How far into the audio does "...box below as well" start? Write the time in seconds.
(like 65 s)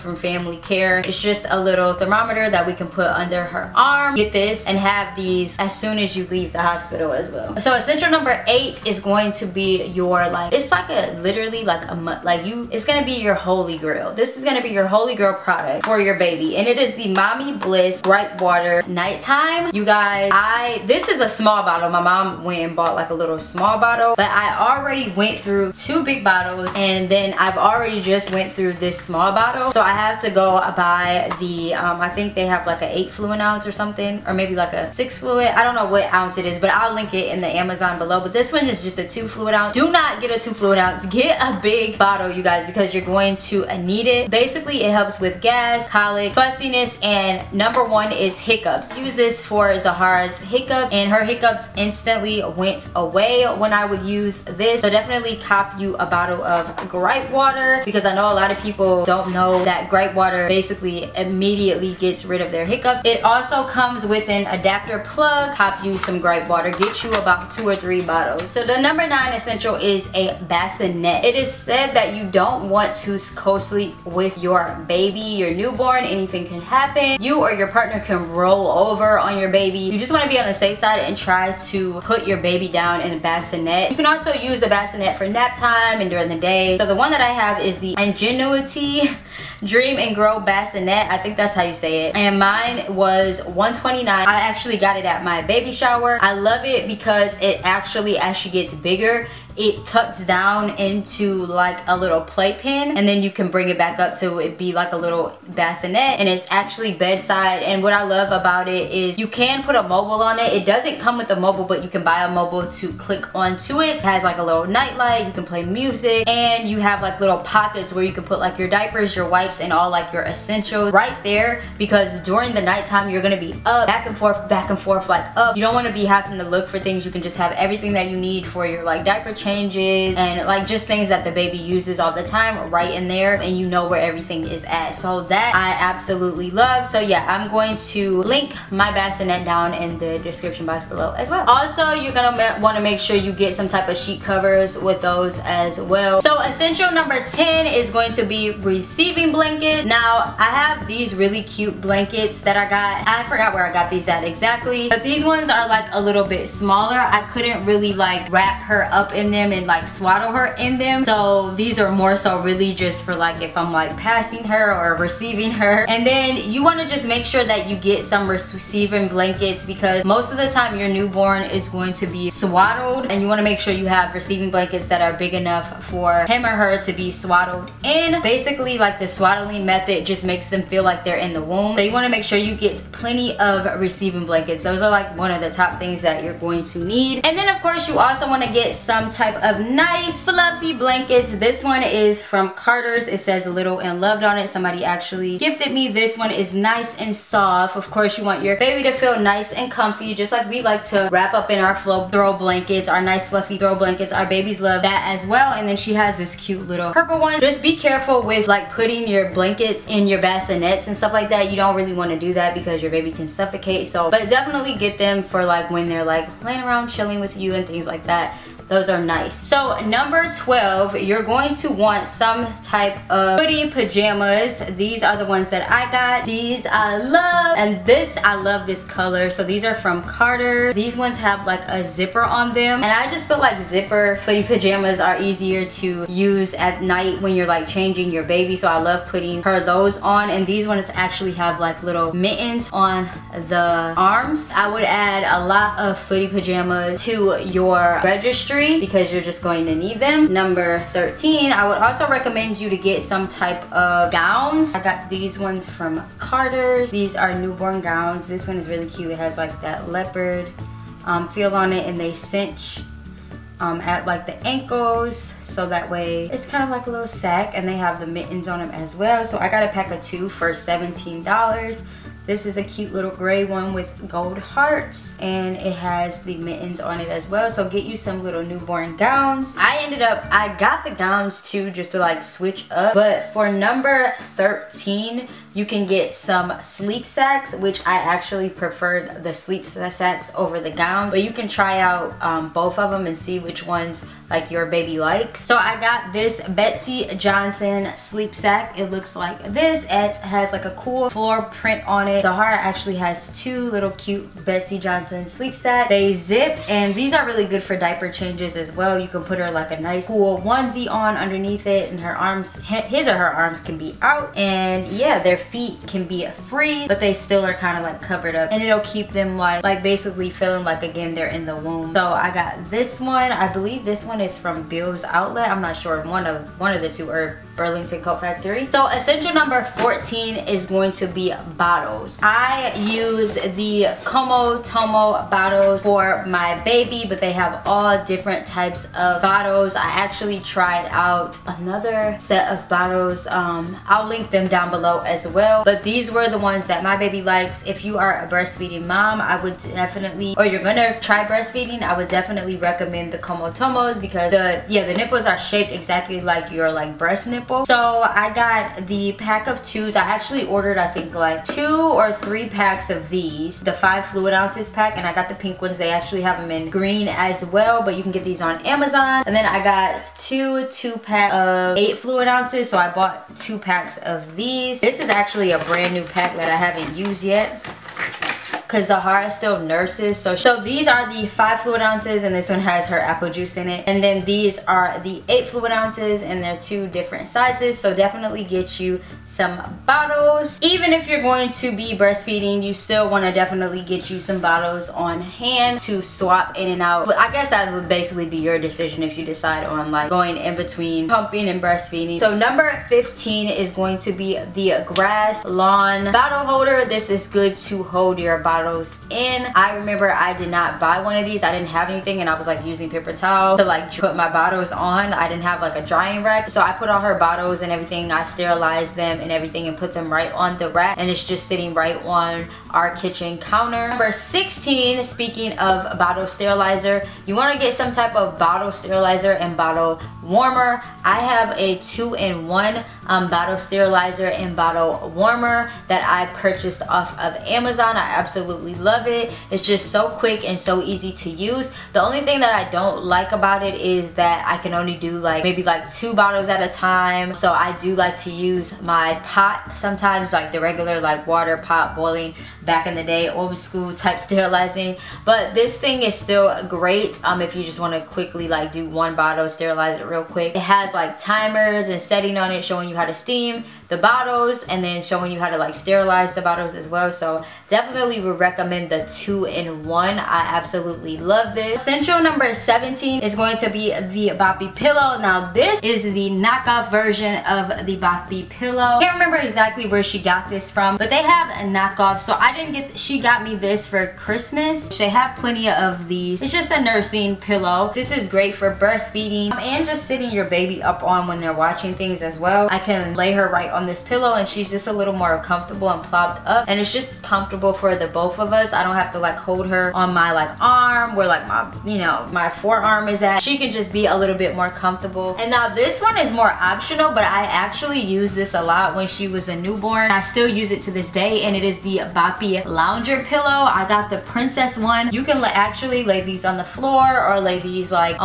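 140 s.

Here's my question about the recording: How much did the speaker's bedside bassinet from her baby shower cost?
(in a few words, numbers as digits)
129.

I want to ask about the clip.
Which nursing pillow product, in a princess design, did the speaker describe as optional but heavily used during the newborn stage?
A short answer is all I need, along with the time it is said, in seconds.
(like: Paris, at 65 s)
Boppy Lounger Pillow, at 512 s.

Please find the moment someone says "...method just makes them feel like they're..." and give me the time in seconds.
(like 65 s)
179 s.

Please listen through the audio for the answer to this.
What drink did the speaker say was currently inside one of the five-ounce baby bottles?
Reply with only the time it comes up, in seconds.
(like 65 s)
382 s.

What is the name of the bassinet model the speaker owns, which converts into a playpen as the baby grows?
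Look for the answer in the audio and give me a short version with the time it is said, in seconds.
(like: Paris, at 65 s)
Ingenuity Dream and Grow, at 87 s.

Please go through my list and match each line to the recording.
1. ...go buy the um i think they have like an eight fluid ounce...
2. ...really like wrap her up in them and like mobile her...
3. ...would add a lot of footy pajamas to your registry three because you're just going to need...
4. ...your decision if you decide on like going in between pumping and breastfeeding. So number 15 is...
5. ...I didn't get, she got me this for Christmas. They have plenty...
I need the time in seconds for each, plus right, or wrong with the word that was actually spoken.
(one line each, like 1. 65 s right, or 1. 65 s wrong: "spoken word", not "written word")
1. 30 s right
2. 157 s wrong: "swaddle", not "mobile"
3. 244 s right
4. 398 s right
5. 482 s right.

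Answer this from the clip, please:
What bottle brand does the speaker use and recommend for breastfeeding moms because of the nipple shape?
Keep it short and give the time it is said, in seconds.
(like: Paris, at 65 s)
Comotomo, at 334 s.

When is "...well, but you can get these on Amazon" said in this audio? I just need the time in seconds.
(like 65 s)
367 s.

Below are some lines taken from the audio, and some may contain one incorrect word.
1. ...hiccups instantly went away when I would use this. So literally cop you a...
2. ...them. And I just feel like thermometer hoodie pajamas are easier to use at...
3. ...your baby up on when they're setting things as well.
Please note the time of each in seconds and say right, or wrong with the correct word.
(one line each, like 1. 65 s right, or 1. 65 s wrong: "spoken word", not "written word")
1. 51 s wrong: "definitely", not "literally"
2. 232 s wrong: "zipper", not "thermometer"
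3. 490 s wrong: "watching", not "setting".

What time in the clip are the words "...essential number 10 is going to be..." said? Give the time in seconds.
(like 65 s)
146 s.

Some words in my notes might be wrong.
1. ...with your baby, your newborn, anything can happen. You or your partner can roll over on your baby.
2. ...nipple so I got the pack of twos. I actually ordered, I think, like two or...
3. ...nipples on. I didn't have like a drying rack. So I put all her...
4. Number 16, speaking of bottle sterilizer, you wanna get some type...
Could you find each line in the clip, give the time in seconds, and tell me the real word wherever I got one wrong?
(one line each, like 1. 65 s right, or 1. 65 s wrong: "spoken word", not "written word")
1. 74 s right
2. 357 s right
3. 414 s wrong: "bottles", not "nipples"
4. 423 s right.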